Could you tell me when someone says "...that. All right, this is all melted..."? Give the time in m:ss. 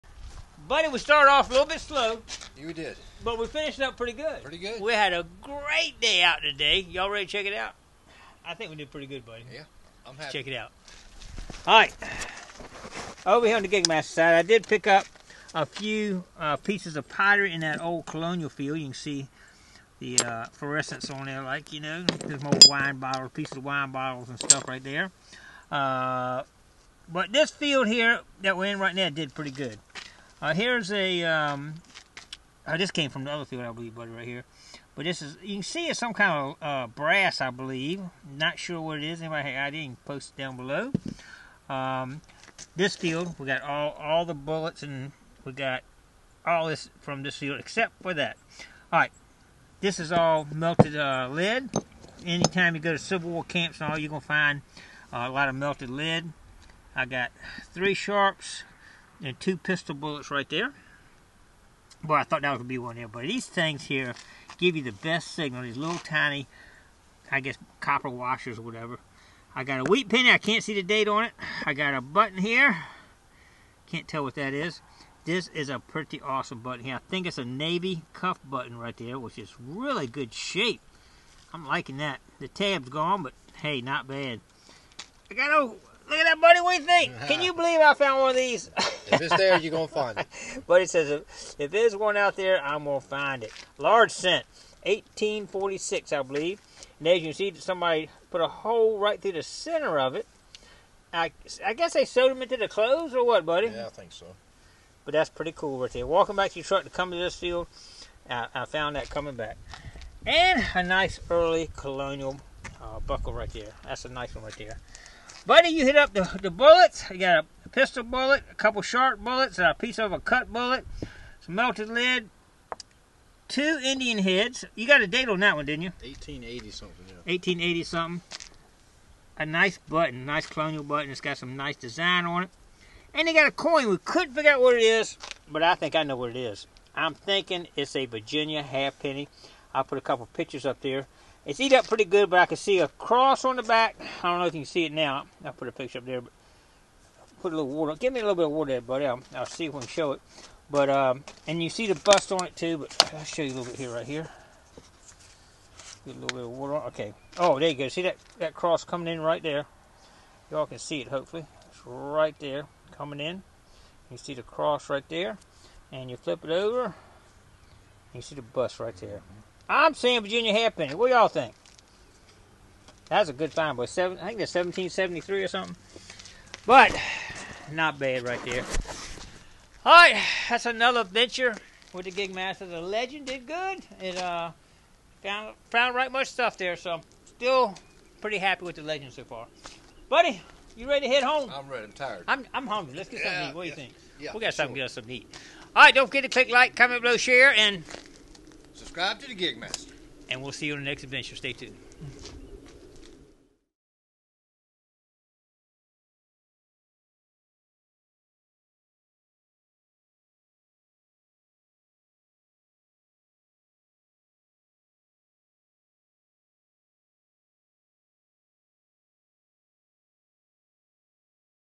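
0:48.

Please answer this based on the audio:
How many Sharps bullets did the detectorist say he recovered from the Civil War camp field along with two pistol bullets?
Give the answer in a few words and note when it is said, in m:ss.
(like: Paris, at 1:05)
3, at 0:57.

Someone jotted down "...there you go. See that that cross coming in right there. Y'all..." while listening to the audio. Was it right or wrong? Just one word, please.
right.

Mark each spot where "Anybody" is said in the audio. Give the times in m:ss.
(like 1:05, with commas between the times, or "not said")
0:39.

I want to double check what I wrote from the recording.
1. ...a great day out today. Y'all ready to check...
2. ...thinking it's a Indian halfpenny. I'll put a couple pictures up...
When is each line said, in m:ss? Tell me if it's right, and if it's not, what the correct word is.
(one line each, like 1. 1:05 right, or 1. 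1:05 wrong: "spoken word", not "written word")
1. 0:05 right
2. 2:17 wrong: "Virginia", not "Indian".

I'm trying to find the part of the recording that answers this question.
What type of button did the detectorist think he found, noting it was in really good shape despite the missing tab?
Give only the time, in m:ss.
1:17.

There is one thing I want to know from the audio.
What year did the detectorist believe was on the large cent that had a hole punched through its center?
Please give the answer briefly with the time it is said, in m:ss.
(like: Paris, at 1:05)
1846, at 1:34.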